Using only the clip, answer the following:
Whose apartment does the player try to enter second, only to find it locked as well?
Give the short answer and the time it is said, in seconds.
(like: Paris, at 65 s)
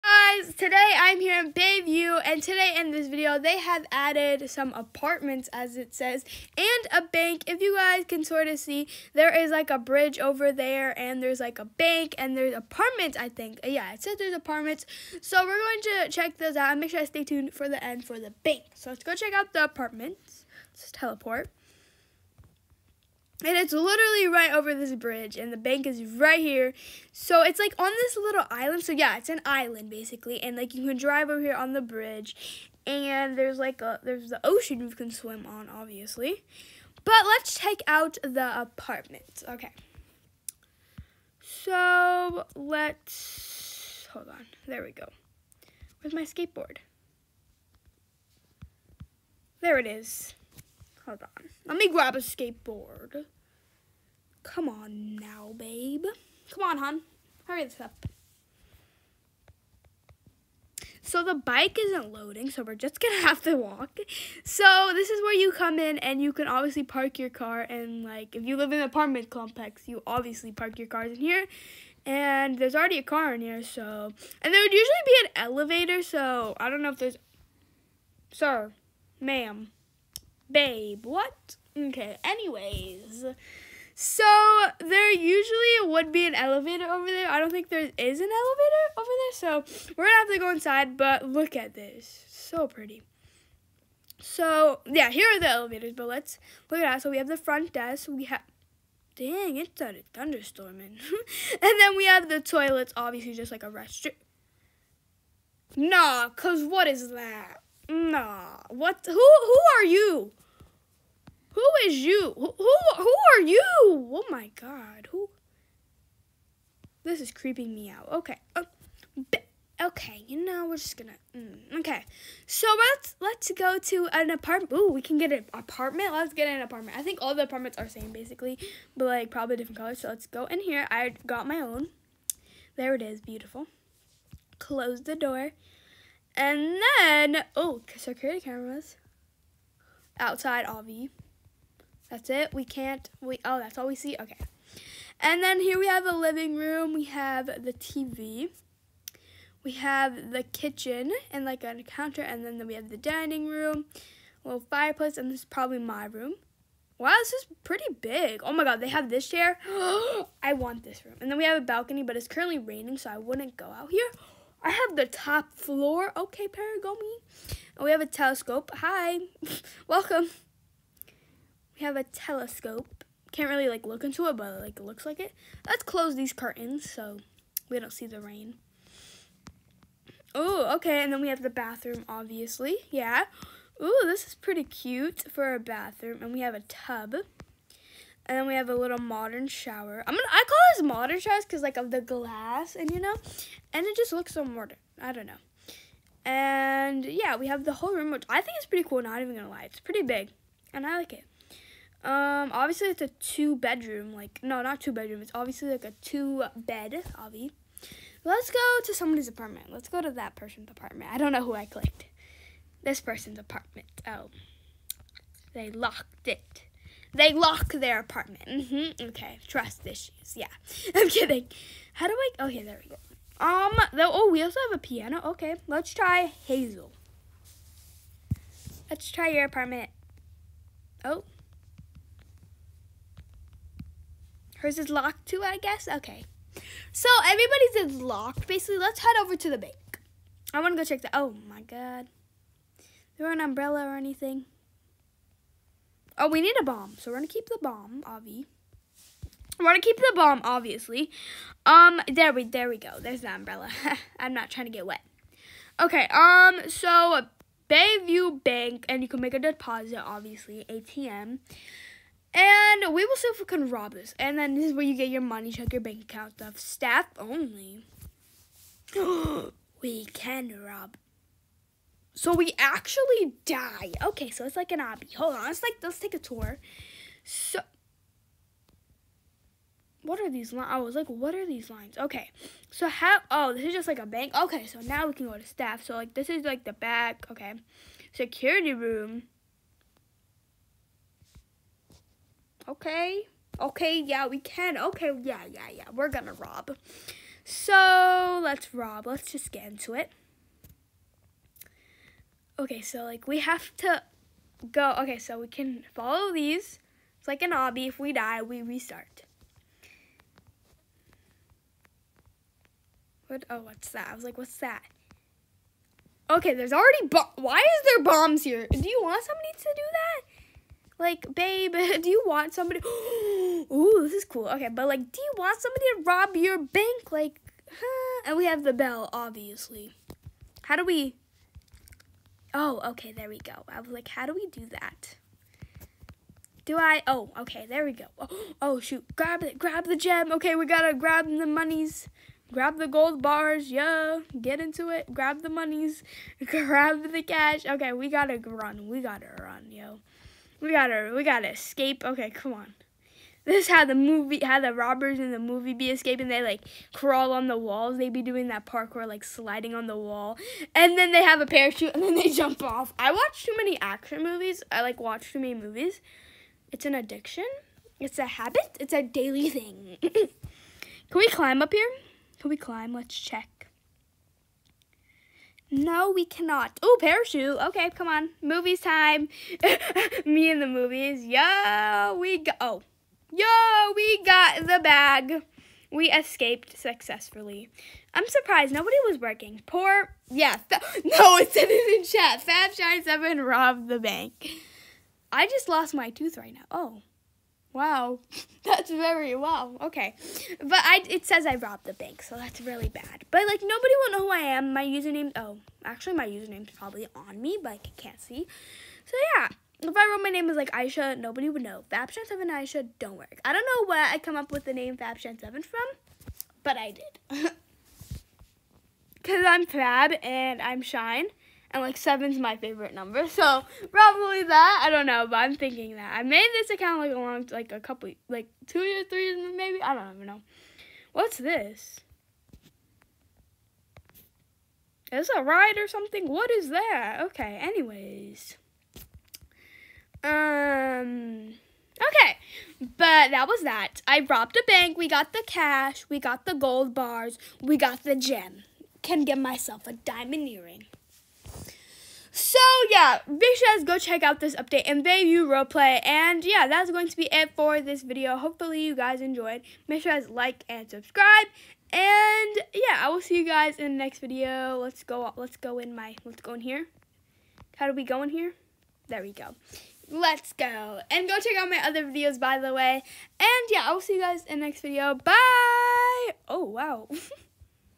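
Hazel, at 226 s.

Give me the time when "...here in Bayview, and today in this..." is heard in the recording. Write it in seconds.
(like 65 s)
1 s.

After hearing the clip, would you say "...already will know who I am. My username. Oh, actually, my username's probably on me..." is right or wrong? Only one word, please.
wrong.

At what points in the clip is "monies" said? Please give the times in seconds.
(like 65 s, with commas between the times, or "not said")
341 s, 345 s.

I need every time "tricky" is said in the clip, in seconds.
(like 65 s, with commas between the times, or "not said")
not said.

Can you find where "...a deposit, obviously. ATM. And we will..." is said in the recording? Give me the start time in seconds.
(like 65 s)
259 s.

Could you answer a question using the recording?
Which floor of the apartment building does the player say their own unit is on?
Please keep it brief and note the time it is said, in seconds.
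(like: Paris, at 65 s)
Top floor, at 165 s.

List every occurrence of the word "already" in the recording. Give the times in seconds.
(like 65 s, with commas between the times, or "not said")
72 s, 316 s.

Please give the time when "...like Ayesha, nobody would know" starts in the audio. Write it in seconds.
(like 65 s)
410 s.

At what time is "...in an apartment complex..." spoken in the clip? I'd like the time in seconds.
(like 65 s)
68 s.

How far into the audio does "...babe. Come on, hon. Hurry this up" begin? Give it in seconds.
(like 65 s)
55 s.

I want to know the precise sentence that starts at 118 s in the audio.
Uh, okay, you know, we're just gonna.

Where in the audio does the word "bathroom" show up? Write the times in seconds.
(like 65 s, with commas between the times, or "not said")
181 s, 185 s.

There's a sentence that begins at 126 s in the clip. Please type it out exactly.
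I think all the apartments are same basically, but like probably different colors.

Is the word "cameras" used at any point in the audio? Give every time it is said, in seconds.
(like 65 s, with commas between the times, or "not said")
138 s.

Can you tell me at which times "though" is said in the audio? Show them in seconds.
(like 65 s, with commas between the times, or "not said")
223 s.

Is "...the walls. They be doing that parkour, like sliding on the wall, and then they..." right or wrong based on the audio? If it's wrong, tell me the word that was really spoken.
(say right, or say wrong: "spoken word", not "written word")
right.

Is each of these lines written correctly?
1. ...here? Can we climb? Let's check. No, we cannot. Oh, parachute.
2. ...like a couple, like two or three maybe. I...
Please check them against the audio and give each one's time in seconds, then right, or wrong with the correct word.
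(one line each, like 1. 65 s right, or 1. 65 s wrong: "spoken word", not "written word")
1. 371 s right
2. 427 s right.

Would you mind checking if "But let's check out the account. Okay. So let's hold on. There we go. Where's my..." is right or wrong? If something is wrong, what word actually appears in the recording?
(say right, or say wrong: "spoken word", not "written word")
wrong: "apartment", not "account".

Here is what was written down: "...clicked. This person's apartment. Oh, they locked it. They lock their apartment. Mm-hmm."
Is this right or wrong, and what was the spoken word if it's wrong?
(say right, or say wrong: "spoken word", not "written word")
right.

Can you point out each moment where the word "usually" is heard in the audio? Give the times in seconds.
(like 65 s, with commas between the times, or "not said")
74 s, 85 s.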